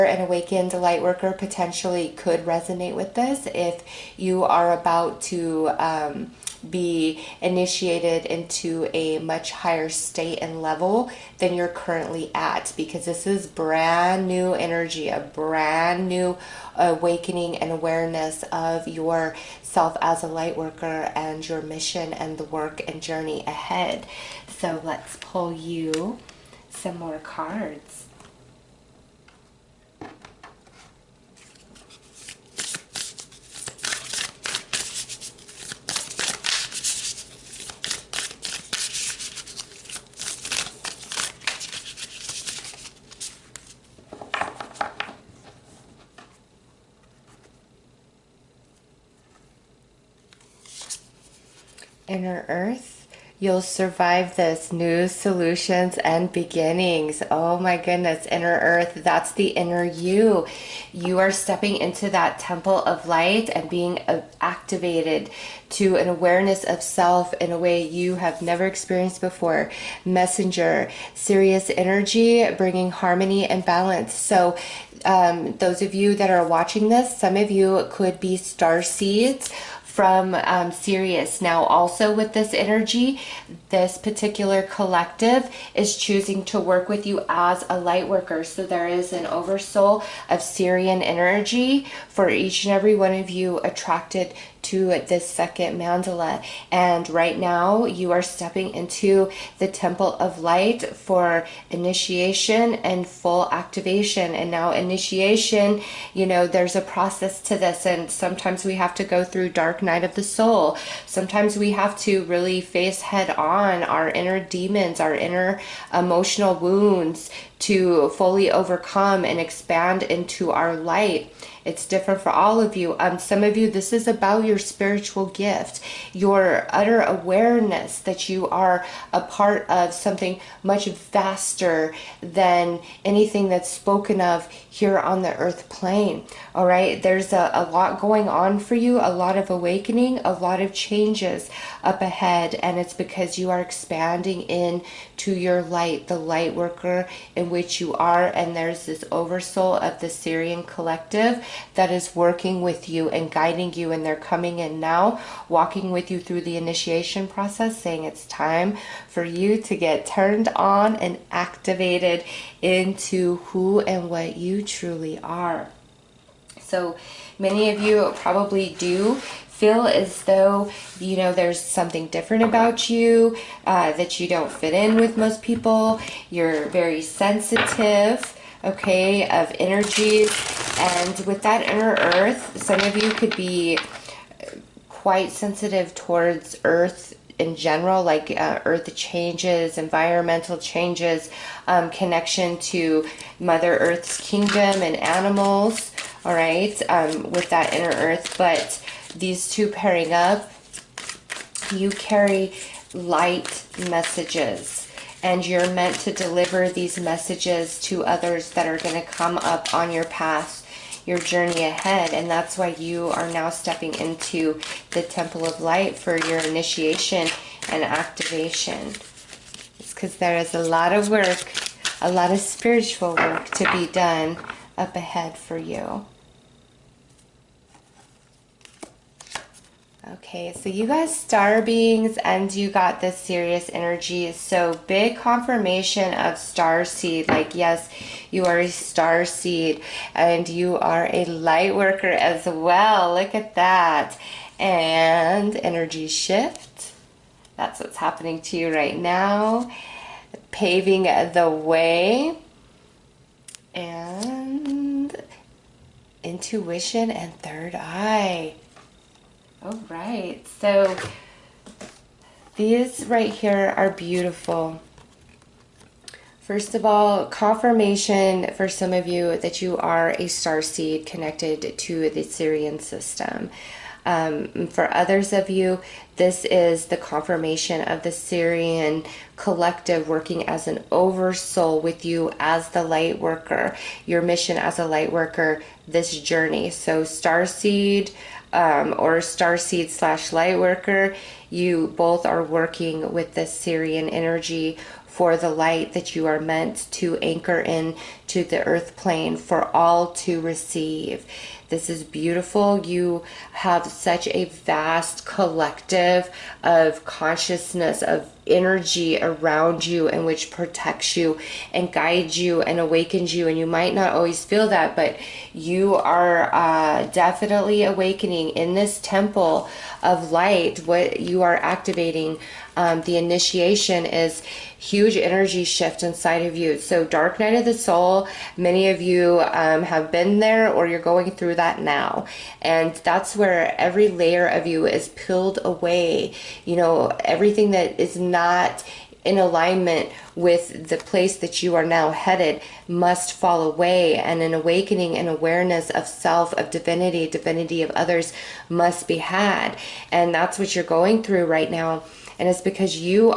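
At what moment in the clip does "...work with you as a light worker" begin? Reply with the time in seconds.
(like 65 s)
86 s.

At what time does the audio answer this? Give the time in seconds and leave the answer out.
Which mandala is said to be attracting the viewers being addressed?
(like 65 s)
95 s.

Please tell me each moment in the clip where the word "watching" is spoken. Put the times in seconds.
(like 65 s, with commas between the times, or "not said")
76 s.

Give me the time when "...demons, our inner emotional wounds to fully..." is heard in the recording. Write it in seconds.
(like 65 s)
114 s.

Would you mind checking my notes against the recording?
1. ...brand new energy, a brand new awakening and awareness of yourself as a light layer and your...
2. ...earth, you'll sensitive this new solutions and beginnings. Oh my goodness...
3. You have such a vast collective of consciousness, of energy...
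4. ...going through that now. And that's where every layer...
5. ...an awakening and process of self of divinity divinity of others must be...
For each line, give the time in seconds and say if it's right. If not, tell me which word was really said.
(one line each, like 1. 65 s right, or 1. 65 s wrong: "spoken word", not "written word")
1. 13 s wrong: "worker", not "layer"
2. 52 s wrong: "survive", not "sensitive"
3. 302 s right
4. 331 s right
5. 344 s wrong: "awareness", not "process".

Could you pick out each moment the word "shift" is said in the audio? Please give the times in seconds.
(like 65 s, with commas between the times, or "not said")
246 s, 325 s.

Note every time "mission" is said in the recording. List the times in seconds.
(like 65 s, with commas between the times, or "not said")
21 s, 284 s.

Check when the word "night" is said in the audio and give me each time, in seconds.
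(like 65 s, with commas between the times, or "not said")
109 s, 327 s.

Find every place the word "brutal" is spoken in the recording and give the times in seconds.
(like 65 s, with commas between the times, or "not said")
not said.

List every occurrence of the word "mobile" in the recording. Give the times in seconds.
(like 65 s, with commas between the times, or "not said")
not said.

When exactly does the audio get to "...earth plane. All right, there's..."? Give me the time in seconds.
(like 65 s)
135 s.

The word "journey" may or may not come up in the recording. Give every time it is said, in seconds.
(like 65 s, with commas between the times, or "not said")
23 s, 211 s, 286 s.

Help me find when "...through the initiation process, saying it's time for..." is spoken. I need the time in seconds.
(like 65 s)
156 s.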